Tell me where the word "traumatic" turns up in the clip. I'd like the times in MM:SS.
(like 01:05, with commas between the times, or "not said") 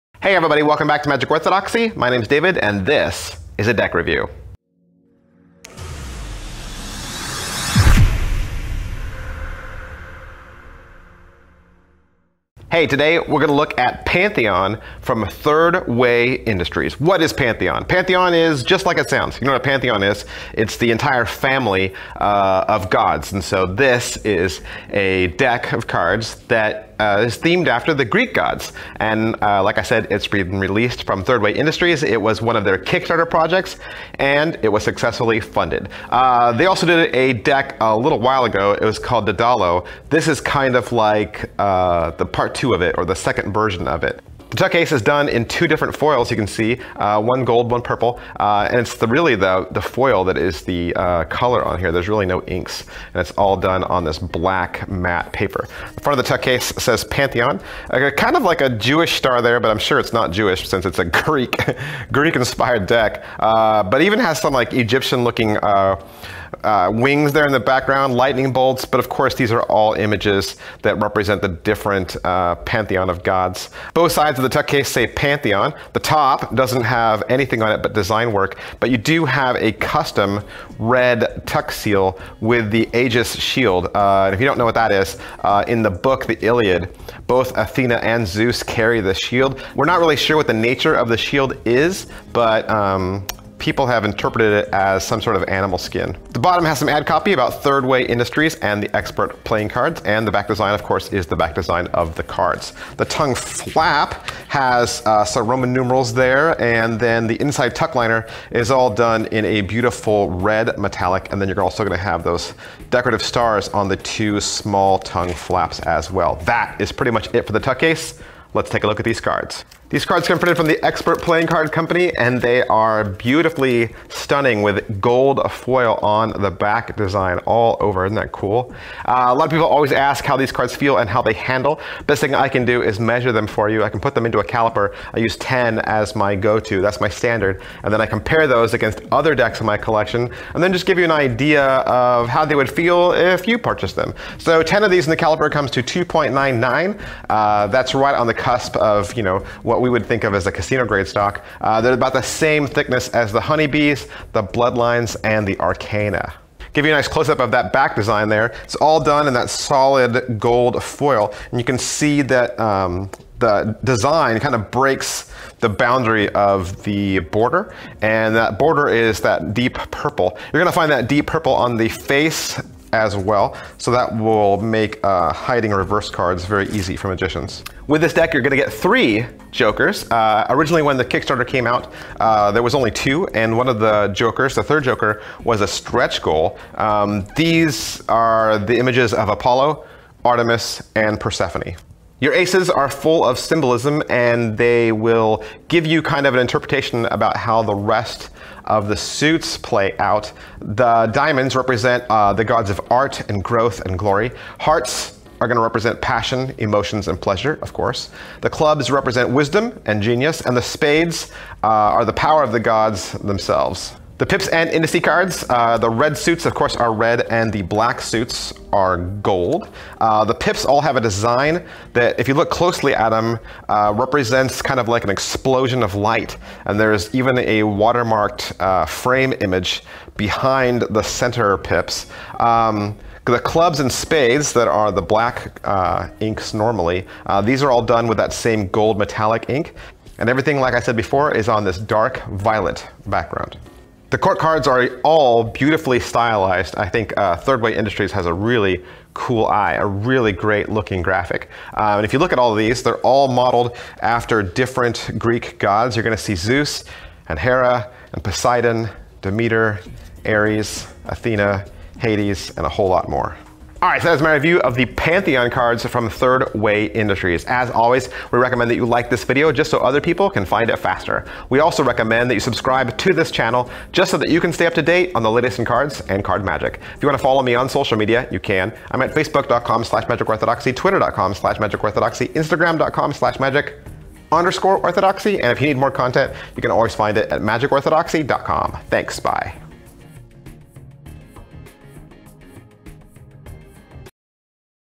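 not said.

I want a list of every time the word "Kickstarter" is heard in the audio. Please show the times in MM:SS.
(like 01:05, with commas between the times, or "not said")
00:32, 03:01.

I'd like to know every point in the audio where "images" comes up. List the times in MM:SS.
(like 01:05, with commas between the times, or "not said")
01:09, 03:08, 03:49.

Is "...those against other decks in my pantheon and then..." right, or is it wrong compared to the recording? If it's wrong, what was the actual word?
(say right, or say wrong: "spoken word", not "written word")
wrong: "collection", not "pantheon".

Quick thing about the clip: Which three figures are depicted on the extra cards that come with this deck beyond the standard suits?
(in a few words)
Apollo, Artemis, and Persephone.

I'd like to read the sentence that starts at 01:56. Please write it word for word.
That is pretty much it for the tuck case.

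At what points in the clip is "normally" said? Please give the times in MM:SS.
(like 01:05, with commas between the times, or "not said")
03:56.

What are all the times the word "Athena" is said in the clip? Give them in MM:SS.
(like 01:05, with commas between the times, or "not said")
01:27, 04:21.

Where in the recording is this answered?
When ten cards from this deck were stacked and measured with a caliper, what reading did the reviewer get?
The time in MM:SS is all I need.
02:25.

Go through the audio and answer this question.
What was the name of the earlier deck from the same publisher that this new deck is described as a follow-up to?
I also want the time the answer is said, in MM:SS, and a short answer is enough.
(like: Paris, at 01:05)
Dedalo, at 00:39.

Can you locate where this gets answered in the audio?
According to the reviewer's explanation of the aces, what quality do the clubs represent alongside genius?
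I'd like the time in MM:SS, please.
03:29.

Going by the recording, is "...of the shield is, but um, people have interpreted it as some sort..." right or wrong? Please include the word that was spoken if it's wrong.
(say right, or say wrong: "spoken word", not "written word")
right.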